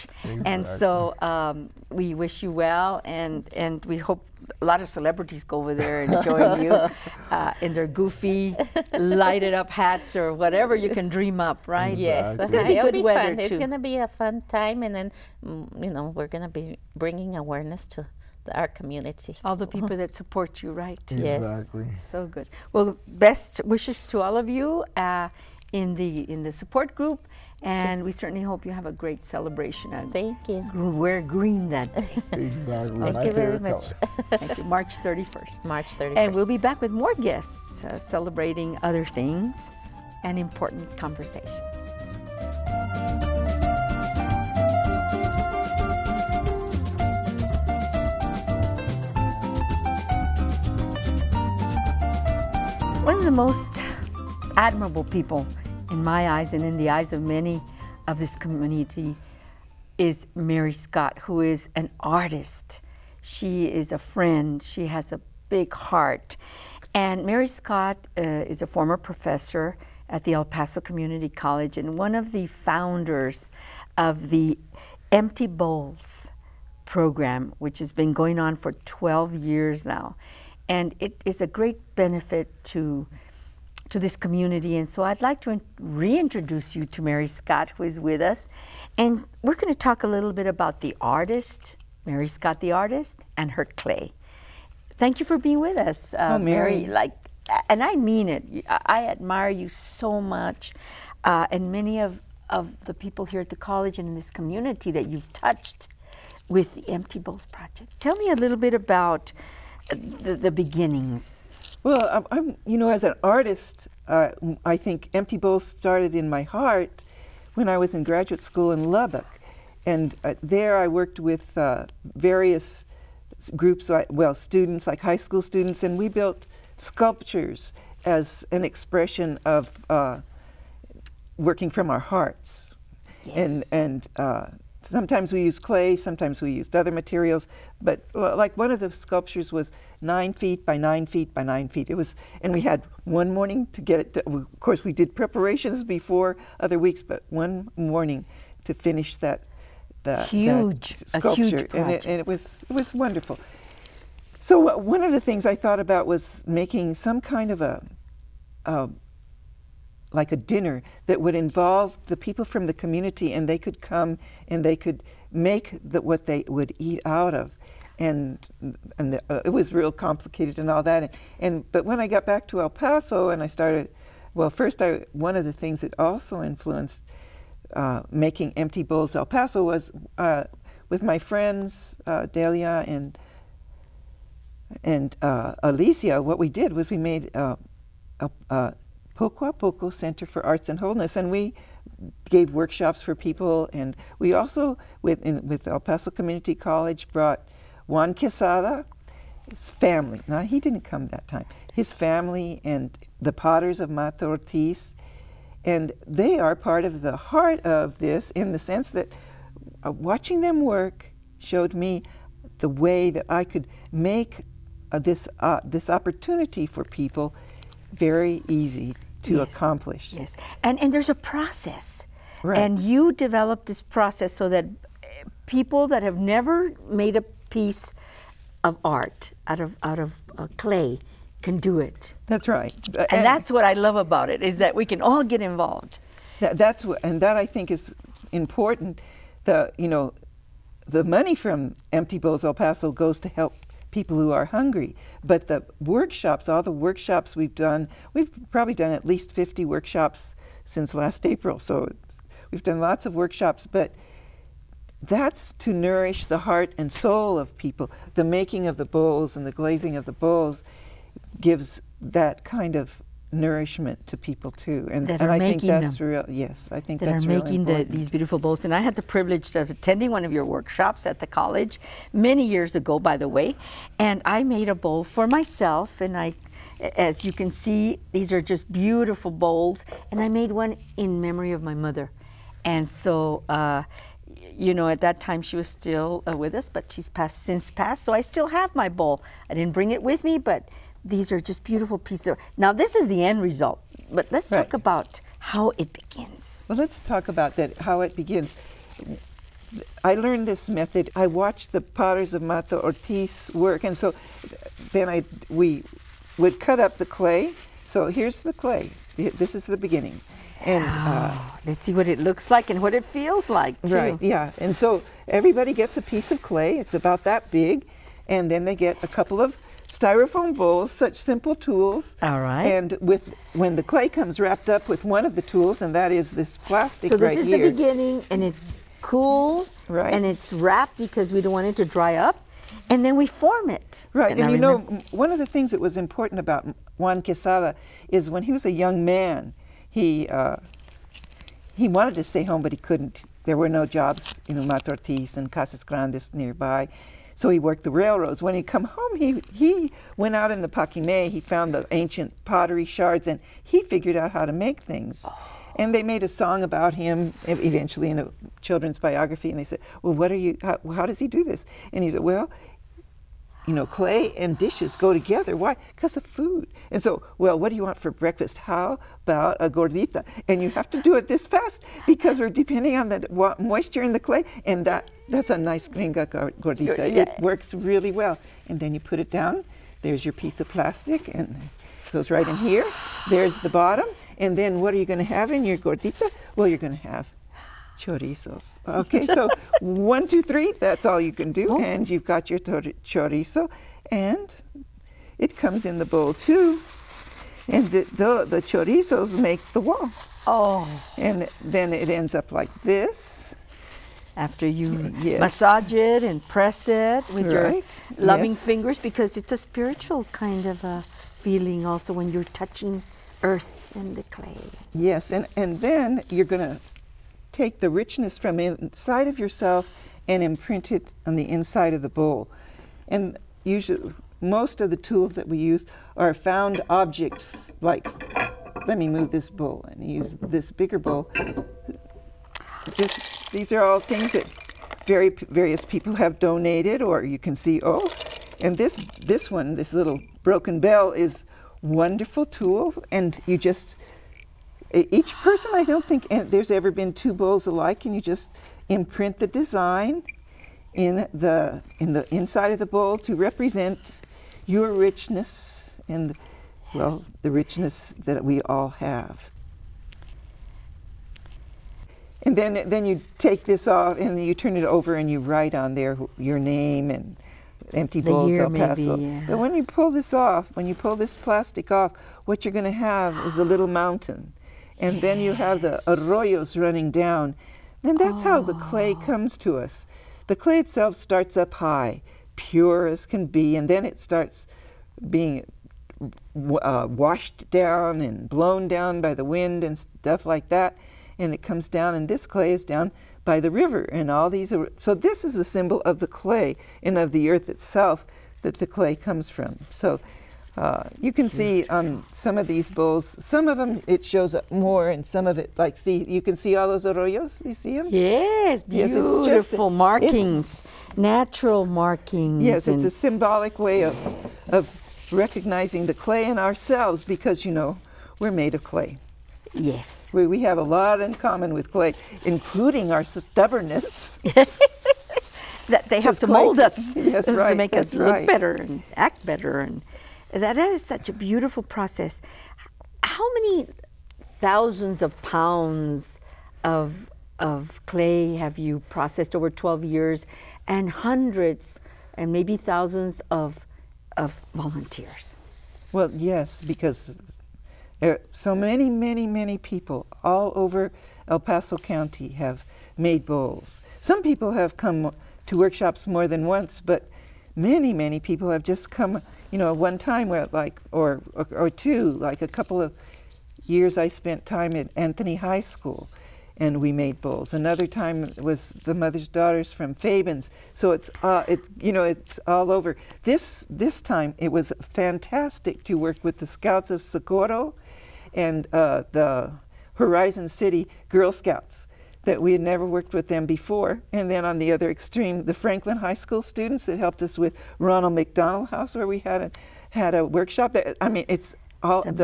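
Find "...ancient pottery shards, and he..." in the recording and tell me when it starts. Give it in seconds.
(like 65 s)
351 s.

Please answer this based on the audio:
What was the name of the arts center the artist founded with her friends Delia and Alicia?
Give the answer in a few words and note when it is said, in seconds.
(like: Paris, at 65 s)
Poco a Poco Center for Arts and Wholeness, at 189 s.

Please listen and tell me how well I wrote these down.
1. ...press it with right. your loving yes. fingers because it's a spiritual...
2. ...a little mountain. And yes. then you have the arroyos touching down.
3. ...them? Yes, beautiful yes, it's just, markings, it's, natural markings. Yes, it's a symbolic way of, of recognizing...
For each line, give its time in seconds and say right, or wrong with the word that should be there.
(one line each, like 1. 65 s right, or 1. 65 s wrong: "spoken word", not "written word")
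1. 406 s right
2. 473 s wrong: "running", not "touching"
3. 507 s right.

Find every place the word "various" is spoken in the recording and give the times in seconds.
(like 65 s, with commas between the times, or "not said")
122 s, 435 s.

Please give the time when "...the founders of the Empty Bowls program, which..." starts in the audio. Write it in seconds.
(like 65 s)
72 s.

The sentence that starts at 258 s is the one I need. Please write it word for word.
The making of the bowls and the glazing of the bowls gives that kind of nourishment to people too.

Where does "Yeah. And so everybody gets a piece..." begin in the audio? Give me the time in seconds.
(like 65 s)
314 s.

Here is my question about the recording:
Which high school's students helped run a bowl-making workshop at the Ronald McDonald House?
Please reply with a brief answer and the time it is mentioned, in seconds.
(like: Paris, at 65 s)
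Franklin High School, at 585 s.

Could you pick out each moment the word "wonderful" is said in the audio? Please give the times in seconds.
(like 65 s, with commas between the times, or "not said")
152 s, 441 s.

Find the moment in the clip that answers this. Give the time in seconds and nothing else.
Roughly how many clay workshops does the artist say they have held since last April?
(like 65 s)
249 s.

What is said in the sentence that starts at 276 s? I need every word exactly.
As you can see, these are just beautiful bowls, and I made one in memory of my mother.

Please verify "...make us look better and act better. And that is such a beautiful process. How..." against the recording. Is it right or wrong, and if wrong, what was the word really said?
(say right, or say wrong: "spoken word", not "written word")
right.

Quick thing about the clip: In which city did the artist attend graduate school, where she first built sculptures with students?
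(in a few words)
Lubbock.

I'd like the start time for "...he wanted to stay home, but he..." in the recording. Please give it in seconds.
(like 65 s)
341 s.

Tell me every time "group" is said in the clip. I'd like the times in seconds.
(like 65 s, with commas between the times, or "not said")
26 s, 123 s.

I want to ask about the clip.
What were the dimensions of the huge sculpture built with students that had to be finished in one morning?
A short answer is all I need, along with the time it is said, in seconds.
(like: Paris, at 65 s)
9 feet by 9 feet by 9 feet, at 140 s.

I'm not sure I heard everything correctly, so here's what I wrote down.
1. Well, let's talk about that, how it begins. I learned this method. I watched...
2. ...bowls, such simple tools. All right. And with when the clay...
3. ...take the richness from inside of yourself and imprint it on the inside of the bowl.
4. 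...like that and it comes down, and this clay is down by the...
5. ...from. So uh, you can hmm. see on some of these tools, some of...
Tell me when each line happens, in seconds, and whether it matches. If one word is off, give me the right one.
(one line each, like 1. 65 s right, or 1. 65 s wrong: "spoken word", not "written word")
1. 296 s right
2. 320 s right
3. 417 s right
4. 490 s right
5. 499 s wrong: "bowls", not "tools".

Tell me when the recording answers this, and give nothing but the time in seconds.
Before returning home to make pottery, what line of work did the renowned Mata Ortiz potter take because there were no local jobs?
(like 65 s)
347 s.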